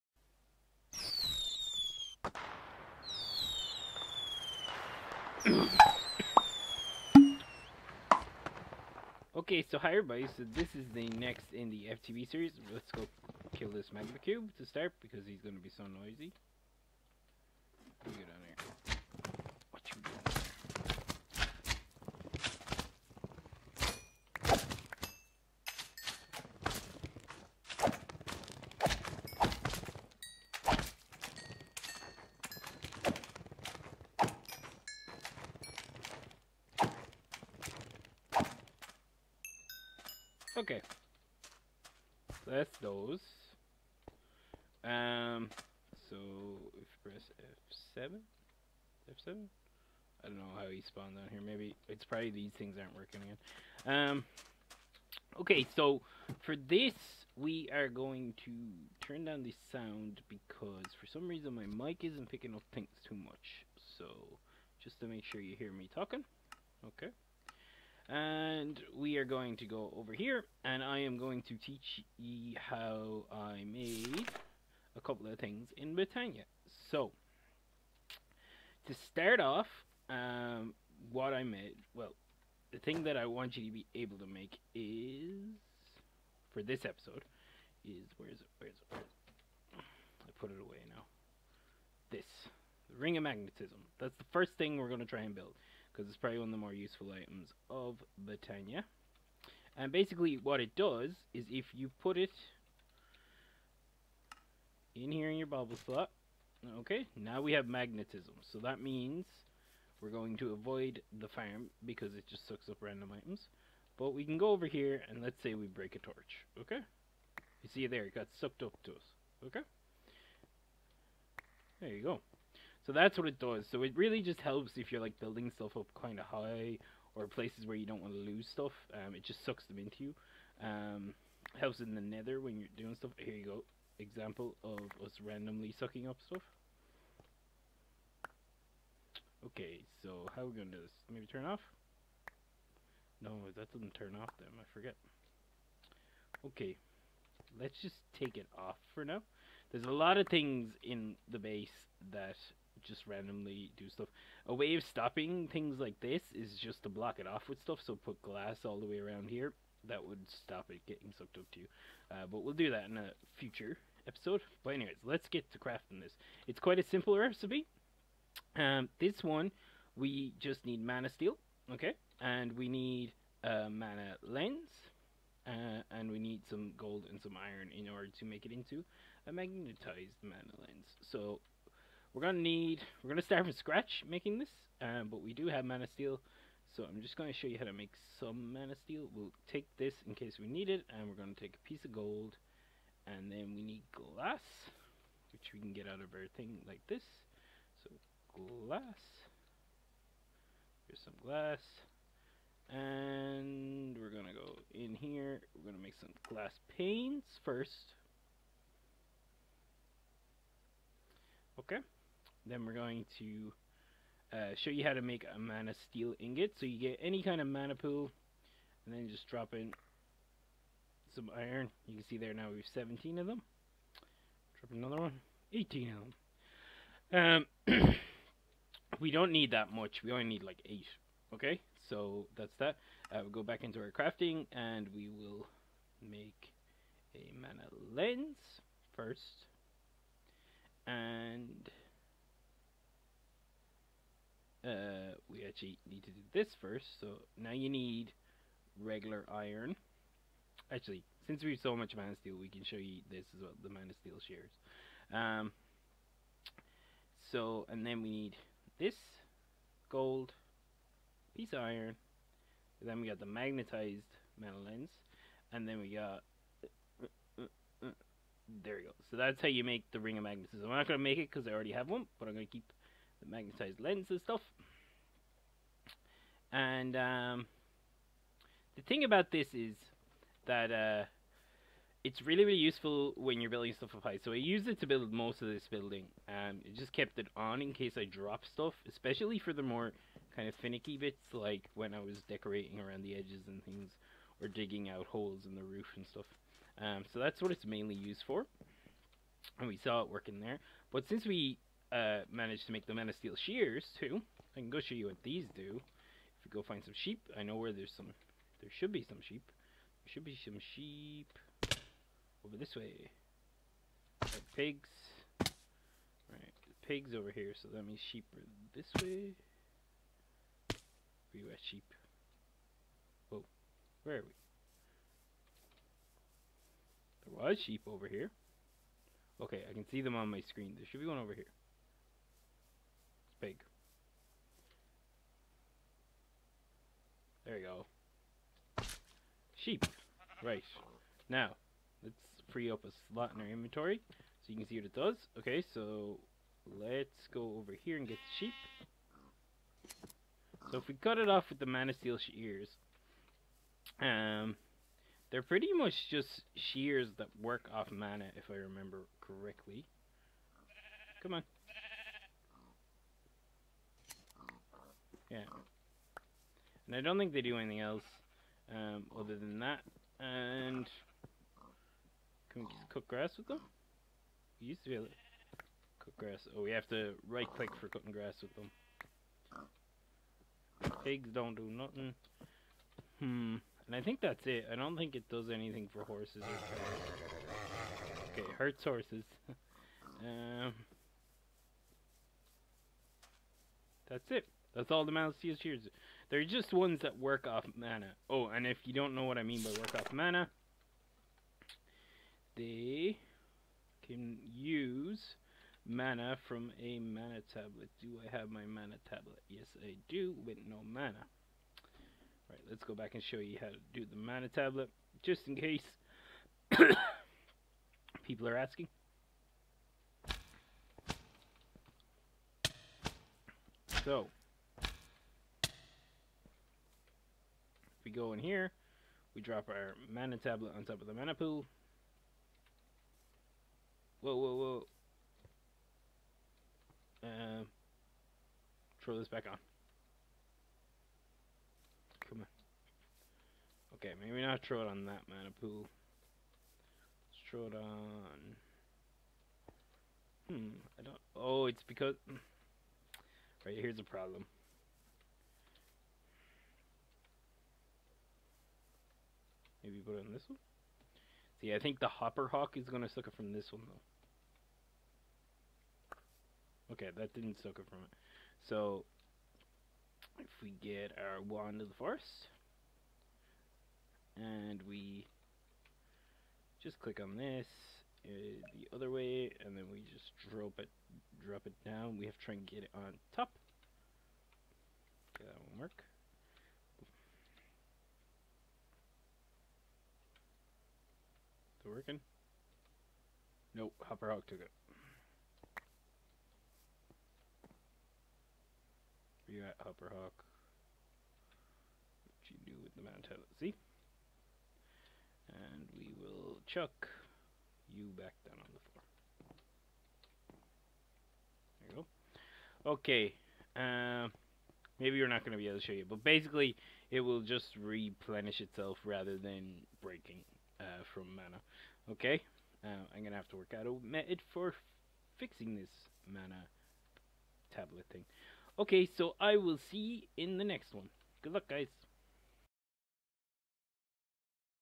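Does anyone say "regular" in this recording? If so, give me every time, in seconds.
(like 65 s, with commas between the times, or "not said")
248 s.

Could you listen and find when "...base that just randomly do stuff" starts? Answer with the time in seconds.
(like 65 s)
151 s.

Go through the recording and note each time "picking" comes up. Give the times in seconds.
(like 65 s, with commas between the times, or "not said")
62 s.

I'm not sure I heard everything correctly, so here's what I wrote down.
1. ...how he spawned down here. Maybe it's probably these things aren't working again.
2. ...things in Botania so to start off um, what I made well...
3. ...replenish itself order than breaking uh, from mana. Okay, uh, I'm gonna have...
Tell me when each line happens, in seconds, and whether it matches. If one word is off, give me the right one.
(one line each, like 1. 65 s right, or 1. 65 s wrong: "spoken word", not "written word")
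1. 50 s right
2. 75 s right
3. 517 s wrong: "rather", not "order".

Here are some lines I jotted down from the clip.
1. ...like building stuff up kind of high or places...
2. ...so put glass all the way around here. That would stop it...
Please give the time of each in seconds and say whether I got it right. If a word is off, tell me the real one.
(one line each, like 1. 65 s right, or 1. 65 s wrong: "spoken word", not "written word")
1. 125 s right
2. 157 s right.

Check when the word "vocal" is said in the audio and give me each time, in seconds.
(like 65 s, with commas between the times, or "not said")
not said.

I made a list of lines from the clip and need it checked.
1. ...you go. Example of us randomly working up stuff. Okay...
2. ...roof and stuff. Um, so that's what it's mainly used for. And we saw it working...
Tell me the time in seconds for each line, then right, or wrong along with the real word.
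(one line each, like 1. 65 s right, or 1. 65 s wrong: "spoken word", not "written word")
1. 133 s wrong: "sucking", not "working"
2. 295 s right.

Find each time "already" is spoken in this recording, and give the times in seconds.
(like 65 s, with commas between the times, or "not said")
271 s.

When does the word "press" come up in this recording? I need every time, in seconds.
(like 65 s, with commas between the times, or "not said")
47 s.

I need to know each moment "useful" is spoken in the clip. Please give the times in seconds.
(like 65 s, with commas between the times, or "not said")
96 s, 282 s.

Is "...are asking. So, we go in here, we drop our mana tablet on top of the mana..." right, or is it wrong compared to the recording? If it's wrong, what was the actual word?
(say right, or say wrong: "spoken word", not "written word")
right.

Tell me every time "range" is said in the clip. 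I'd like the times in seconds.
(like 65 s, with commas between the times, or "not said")
not said.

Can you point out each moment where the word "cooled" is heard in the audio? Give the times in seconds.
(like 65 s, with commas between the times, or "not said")
not said.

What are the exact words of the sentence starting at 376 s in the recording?
Oh, we have to right click for cutting grass with them.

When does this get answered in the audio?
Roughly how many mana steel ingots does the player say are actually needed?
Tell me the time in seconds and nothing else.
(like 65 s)
230 s.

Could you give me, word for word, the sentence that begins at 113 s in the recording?
But we can go over here and let's say we break a torch, okay?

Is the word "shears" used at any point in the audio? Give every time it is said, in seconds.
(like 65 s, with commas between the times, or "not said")
303 s, 352 s, 356 s, 395 s.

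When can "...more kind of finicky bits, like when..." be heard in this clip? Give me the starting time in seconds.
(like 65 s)
289 s.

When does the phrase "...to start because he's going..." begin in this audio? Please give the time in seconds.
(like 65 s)
14 s.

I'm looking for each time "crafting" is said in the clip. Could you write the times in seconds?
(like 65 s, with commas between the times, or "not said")
165 s, 233 s.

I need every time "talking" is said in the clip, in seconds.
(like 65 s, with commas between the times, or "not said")
65 s.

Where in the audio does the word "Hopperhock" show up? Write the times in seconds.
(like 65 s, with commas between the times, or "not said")
462 s, 494 s, 499 s.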